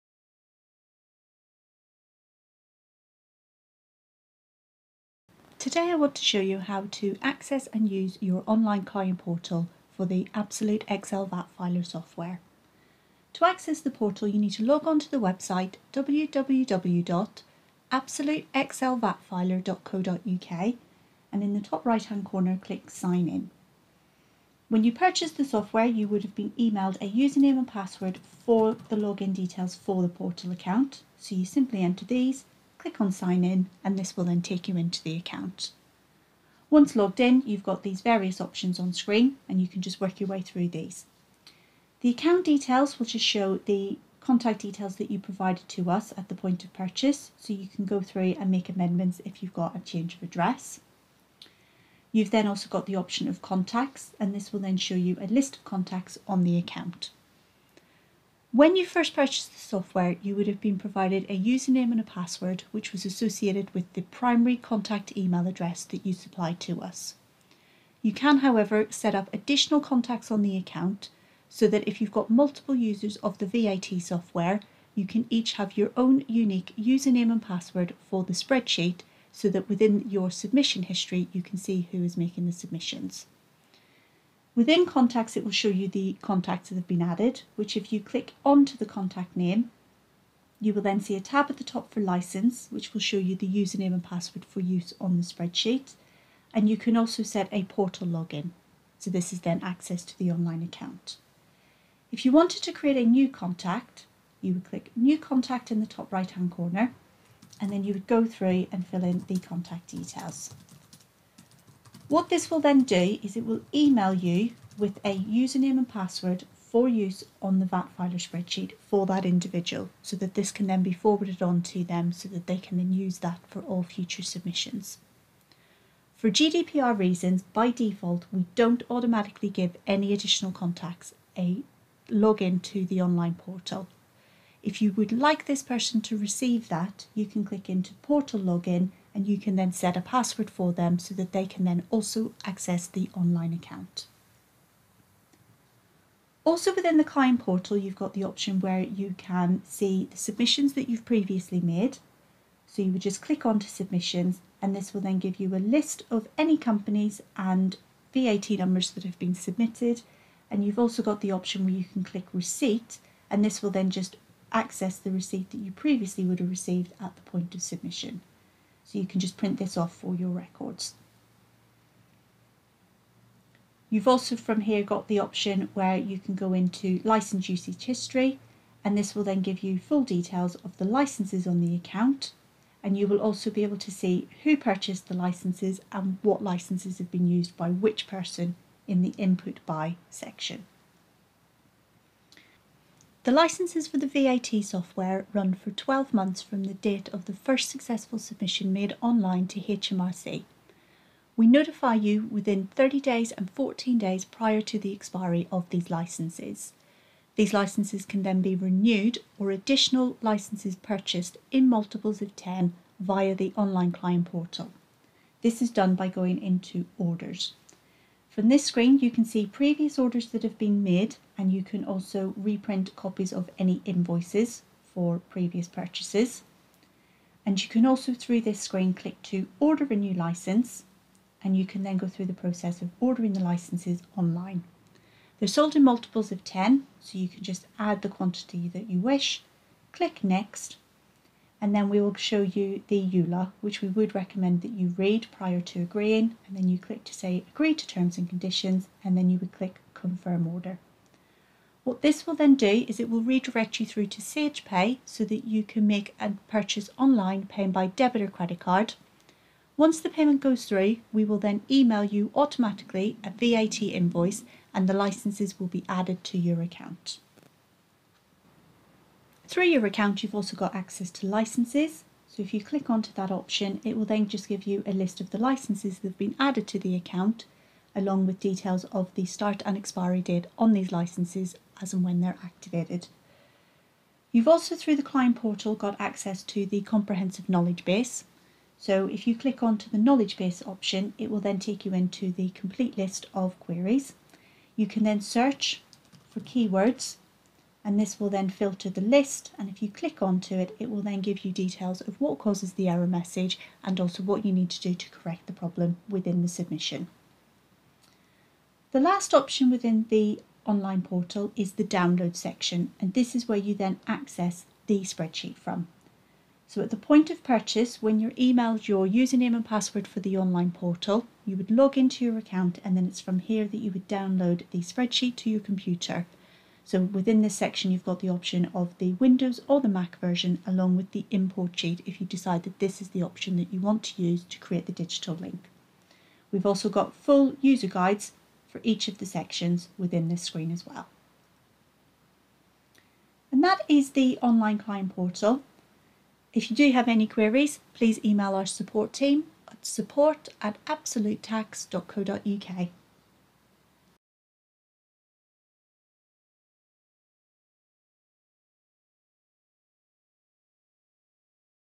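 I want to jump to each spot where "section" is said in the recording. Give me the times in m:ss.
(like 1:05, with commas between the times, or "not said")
3:10, 5:12, 5:27, 5:39.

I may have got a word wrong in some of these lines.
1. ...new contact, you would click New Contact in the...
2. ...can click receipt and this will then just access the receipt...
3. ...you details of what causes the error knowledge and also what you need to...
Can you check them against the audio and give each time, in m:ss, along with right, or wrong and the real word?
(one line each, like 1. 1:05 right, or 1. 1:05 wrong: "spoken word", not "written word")
1. 1:43 right
2. 2:41 right
3. 5:01 wrong: "message", not "knowledge".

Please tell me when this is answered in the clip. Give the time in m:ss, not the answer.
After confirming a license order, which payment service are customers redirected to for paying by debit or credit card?
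4:14.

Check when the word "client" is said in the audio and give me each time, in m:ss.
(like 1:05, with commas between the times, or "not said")
0:08, 2:27, 3:33, 4:45, 5:44.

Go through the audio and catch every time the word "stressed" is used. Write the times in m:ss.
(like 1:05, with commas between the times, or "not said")
not said.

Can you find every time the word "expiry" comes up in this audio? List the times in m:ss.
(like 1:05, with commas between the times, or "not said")
3:24, 4:39.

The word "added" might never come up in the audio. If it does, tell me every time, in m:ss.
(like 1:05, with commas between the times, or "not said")
1:27, 4:25, 4:36.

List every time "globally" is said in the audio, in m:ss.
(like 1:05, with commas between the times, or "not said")
not said.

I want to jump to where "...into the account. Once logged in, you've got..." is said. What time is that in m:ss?
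0:34.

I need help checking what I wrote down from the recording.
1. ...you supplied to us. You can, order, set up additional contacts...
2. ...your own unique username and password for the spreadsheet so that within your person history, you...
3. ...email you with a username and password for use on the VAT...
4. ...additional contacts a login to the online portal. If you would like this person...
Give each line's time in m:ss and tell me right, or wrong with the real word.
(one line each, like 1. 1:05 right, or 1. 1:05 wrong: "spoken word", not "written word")
1. 1:06 wrong: "however", not "order"
2. 1:15 wrong: "submission", not "person"
3. 1:53 right
4. 2:10 right.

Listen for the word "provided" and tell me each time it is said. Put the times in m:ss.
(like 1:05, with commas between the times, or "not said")
0:45, 1:00.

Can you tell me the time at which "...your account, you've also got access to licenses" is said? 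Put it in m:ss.
4:29.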